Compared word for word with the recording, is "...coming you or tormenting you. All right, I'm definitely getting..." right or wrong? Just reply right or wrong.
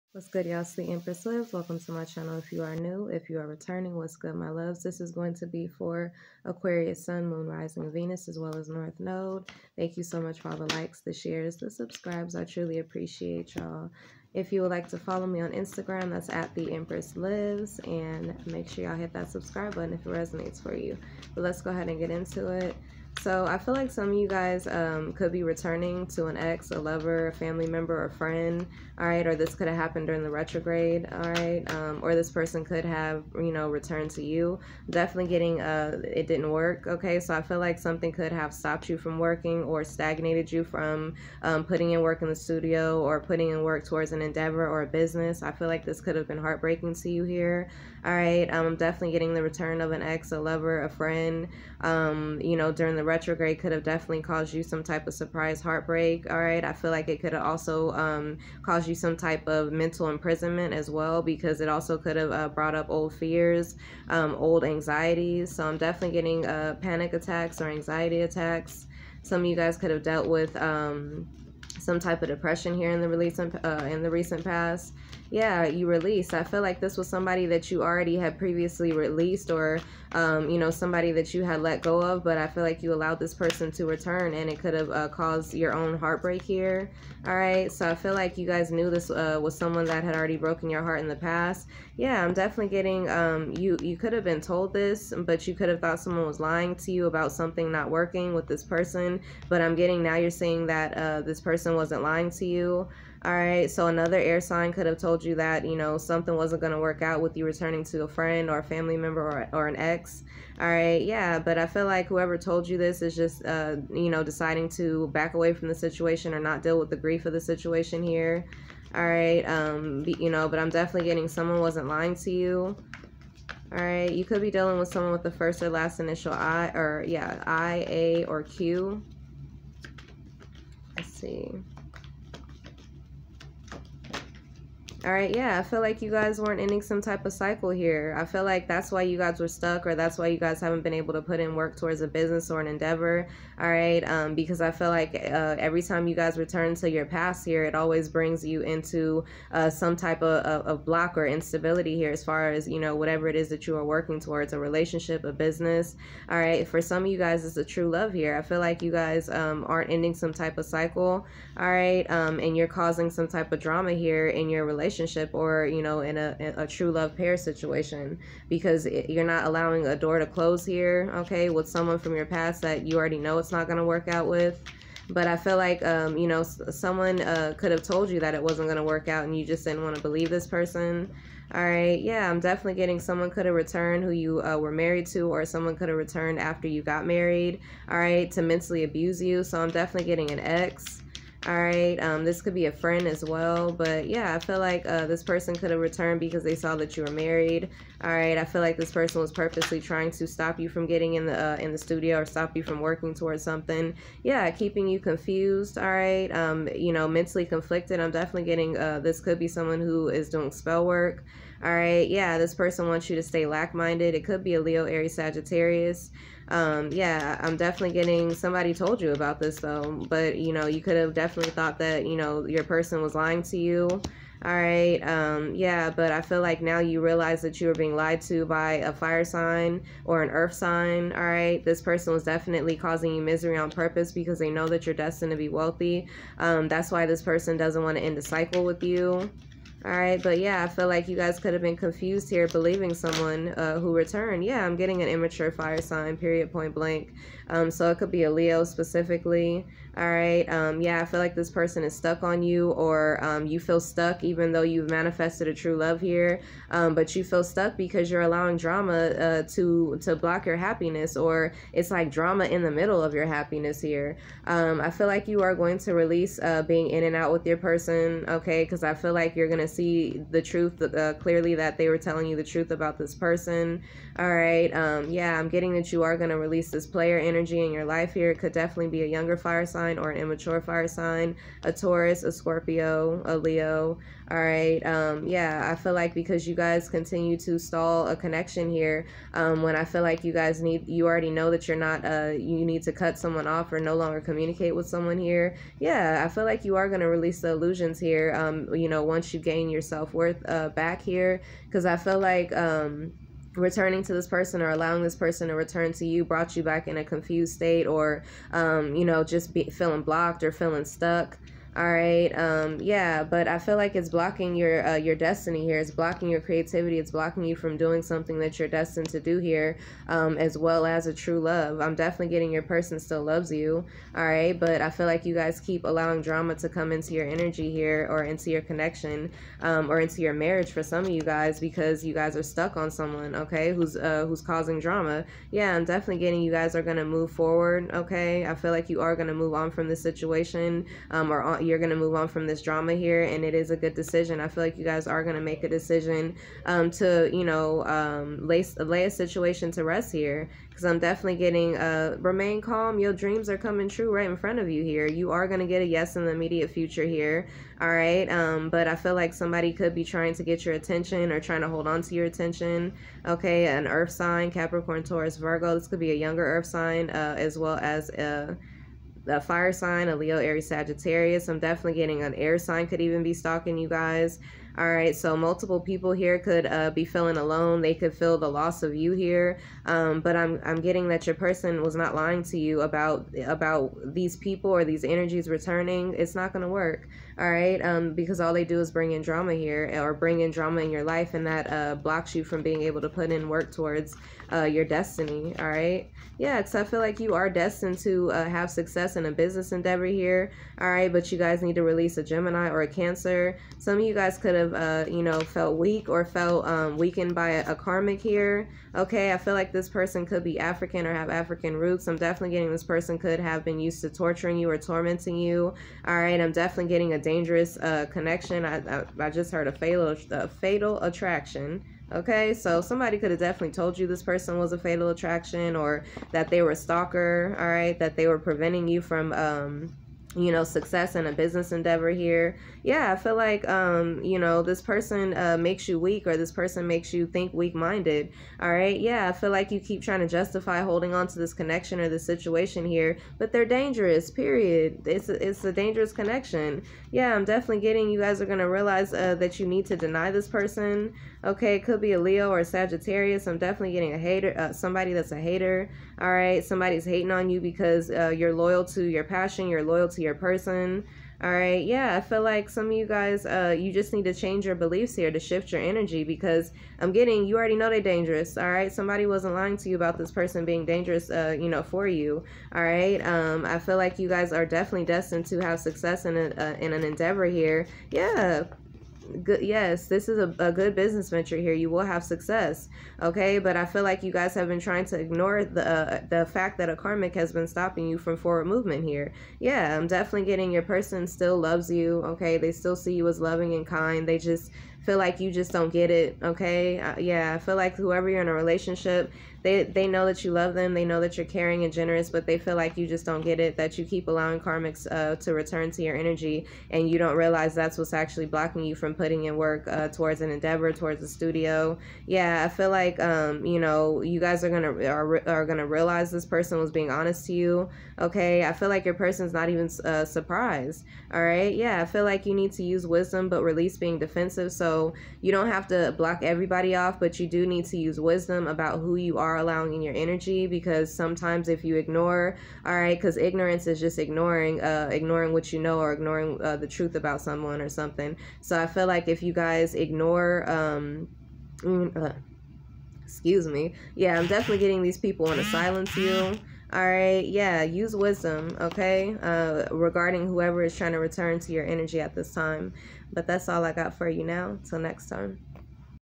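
wrong.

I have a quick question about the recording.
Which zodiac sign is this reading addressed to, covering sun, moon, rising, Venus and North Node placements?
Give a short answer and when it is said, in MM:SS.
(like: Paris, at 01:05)
Aquarius, at 00:06.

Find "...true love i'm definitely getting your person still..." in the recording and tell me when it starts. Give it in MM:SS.
05:21.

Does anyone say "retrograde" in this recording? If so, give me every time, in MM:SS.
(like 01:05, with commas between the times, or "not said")
00:30, 00:53.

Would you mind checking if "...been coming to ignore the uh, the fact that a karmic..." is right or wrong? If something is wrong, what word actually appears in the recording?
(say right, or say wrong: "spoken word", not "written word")
wrong: "trying", not "coming".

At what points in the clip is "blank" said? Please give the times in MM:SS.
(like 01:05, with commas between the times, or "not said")
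04:06.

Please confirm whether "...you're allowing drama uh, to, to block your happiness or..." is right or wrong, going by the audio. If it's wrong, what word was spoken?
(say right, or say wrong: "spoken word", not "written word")
right.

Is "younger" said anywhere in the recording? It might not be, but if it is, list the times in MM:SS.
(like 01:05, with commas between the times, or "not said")
04:39, 06:06.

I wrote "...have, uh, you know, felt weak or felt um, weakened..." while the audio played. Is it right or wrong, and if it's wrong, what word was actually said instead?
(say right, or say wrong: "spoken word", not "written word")
right.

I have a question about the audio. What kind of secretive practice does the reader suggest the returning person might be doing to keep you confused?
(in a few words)
Spell work.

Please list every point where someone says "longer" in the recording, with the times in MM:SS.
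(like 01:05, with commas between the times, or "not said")
04:53.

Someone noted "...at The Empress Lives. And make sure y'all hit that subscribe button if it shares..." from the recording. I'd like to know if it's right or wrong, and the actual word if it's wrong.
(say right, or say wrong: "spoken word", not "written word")
wrong: "resonates", not "shares".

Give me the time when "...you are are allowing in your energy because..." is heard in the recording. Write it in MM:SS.
08:49.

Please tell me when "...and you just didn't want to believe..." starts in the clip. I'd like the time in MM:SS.
02:59.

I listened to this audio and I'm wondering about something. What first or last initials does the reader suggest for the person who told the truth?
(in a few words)
I, A, or Q.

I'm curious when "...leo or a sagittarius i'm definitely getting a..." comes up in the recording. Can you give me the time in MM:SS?
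07:32.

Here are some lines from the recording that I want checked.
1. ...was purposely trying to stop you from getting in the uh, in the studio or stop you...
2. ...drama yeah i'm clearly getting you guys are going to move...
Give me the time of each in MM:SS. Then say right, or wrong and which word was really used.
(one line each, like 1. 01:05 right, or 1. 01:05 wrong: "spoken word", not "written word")
1. 03:19 right
2. 05:34 wrong: "definitely", not "clearly".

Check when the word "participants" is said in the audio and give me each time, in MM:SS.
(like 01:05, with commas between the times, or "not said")
not said.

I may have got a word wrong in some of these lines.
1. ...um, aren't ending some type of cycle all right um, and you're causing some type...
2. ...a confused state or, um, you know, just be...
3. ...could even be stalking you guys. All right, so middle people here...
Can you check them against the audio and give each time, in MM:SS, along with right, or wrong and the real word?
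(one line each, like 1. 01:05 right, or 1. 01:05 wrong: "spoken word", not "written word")
1. 02:39 right
2. 05:06 right
3. 06:12 wrong: "multiple", not "middle".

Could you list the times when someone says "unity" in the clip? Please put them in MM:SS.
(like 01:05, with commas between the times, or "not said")
not said.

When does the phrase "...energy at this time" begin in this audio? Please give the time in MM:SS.
09:11.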